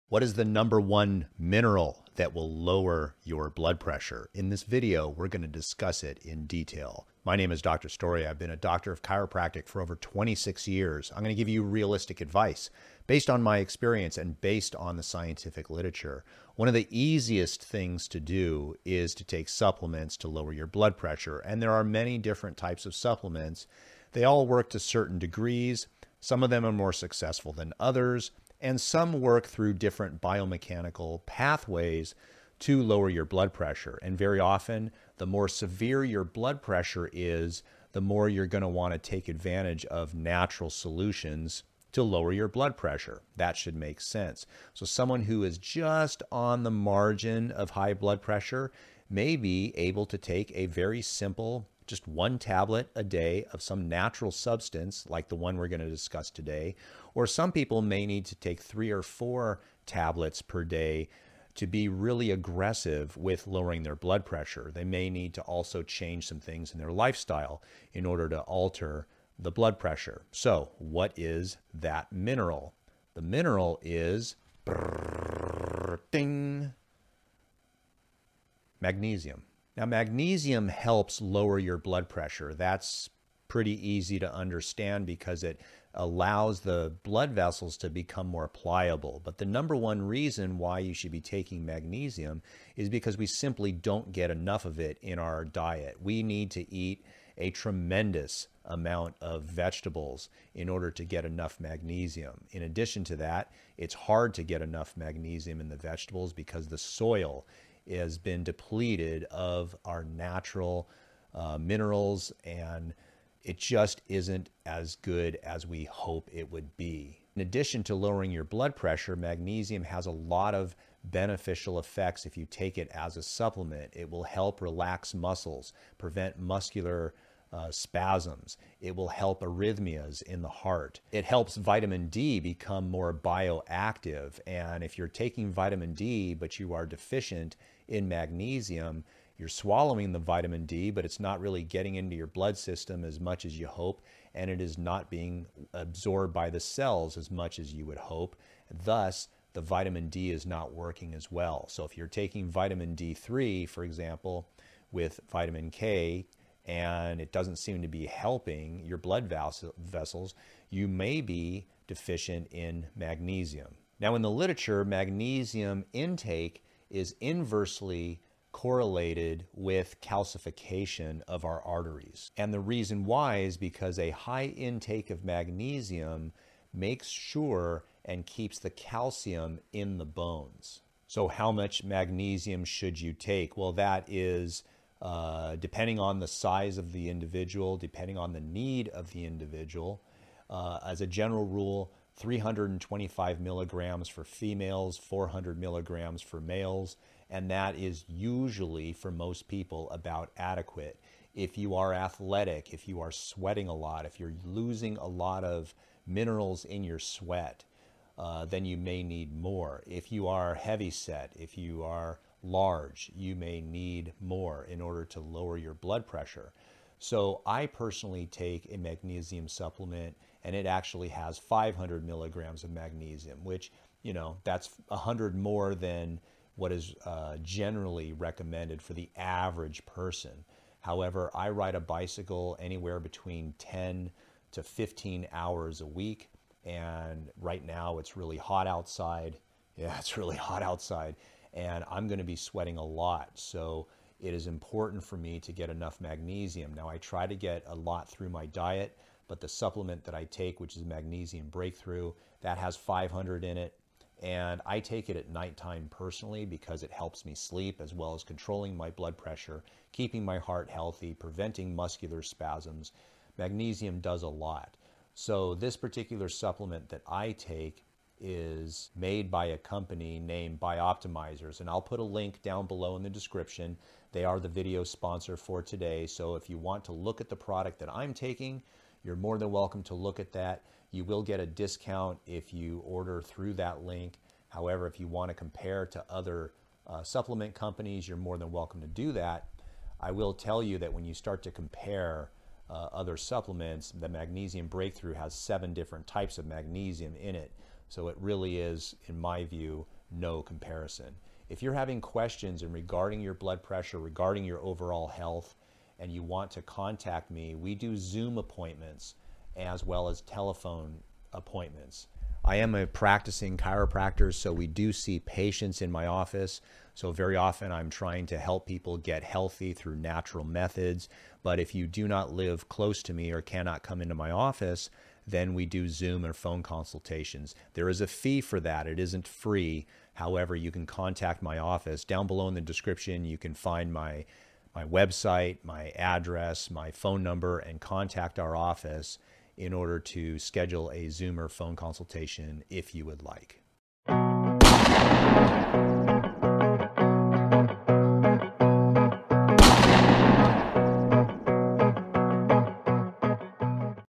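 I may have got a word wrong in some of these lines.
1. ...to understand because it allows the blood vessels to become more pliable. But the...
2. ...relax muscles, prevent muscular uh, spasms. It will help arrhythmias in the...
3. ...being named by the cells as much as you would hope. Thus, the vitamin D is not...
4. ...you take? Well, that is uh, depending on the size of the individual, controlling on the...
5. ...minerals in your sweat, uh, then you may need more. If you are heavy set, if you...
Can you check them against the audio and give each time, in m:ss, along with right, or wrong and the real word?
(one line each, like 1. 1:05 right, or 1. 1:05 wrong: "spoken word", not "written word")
1. 1:24 right
2. 2:04 right
3. 2:25 wrong: "absorbed", not "named"
4. 3:03 wrong: "depending", not "controlling"
5. 3:26 right.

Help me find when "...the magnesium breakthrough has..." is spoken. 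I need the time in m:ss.
4:53.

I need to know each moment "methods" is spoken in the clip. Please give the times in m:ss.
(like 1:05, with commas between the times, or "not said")
5:20.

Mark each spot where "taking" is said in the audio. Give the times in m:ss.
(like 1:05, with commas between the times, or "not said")
1:31, 2:15, 2:32, 4:38.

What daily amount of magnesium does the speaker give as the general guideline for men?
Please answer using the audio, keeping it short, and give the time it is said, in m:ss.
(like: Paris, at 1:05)
400 milligrams, at 3:14.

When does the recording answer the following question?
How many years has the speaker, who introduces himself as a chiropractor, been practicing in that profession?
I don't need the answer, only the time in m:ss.
0:09.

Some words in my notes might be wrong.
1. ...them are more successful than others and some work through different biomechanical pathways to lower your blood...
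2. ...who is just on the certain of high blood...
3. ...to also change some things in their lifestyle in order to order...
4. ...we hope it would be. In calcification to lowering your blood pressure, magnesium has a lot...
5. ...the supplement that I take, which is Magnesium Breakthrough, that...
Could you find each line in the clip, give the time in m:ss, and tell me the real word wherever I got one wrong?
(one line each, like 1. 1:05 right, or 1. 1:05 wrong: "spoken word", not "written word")
1. 0:26 right
2. 0:45 wrong: "margin", not "certain"
3. 1:05 wrong: "alter", not "order"
4. 1:55 wrong: "addition", not "calcification"
5. 4:09 right.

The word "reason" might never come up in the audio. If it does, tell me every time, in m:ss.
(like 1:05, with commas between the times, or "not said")
1:30, 2:52.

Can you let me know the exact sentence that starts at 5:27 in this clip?
There is a fee for that.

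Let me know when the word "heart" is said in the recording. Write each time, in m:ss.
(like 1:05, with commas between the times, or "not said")
2:10, 4:20.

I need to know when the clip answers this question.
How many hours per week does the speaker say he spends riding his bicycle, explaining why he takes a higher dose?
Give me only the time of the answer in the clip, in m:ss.
3:53.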